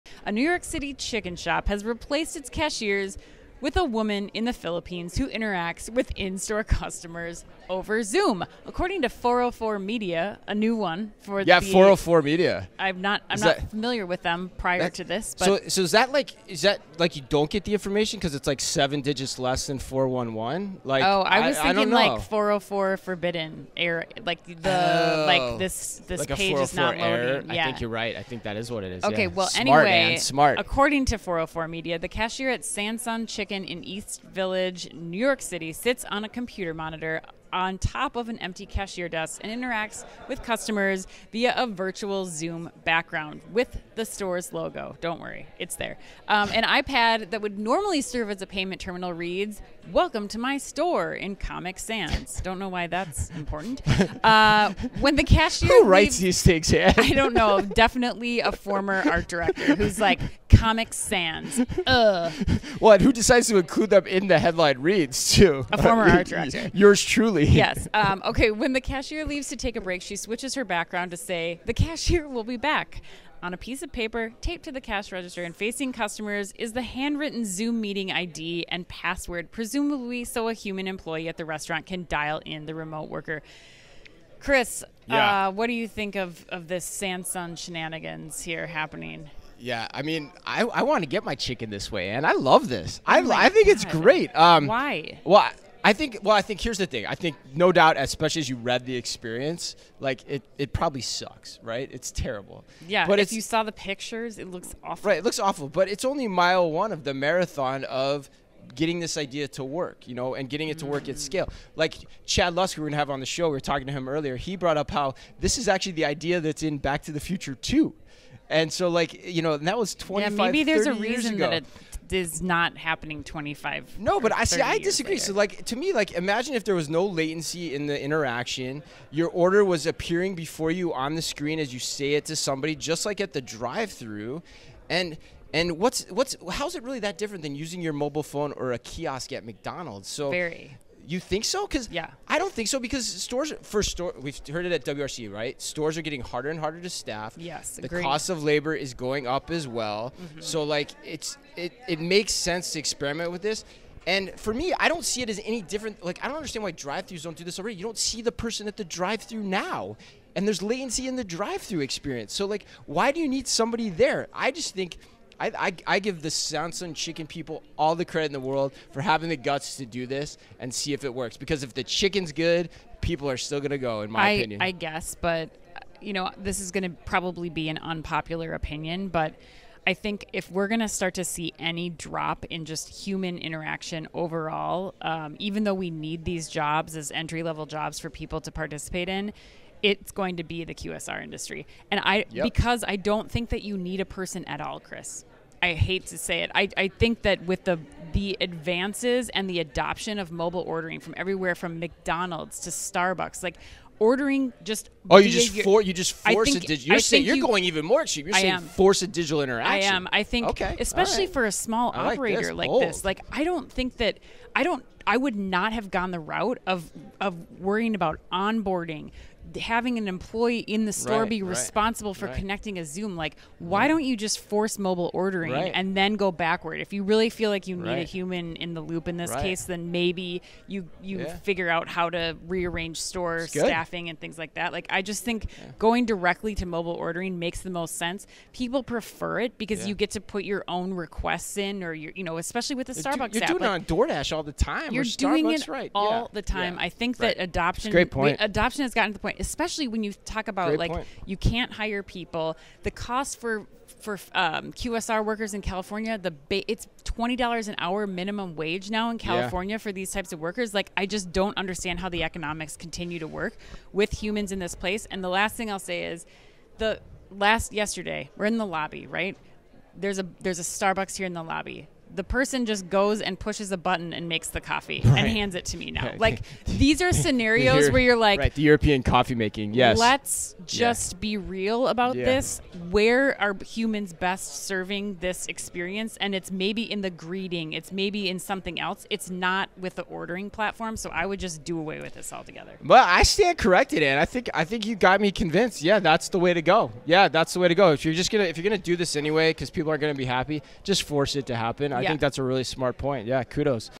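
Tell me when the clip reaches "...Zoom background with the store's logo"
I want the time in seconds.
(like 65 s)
42 s.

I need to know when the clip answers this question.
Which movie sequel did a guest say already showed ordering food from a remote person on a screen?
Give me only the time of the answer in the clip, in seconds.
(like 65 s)
116 s.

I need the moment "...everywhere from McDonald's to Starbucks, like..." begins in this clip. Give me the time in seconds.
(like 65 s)
201 s.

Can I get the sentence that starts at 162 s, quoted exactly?
So like, why do you need somebody there?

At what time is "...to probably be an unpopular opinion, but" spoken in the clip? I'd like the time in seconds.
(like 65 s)
176 s.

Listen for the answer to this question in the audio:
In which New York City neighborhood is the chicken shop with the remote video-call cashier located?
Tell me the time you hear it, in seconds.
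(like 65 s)
33 s.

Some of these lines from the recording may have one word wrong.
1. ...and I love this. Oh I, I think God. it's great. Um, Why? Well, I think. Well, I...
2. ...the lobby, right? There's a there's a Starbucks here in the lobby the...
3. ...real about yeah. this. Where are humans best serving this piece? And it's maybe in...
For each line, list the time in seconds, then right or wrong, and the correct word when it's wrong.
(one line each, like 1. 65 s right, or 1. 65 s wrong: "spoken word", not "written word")
1. 92 s right
2. 268 s right
3. 281 s wrong: "experience", not "piece".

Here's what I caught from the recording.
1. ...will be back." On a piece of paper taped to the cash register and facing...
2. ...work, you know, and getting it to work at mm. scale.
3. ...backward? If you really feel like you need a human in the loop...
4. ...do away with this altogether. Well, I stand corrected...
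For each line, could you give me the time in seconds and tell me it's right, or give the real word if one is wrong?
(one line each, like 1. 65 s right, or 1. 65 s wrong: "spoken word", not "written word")
1. 72 s right
2. 109 s right
3. 226 s right
4. 291 s right.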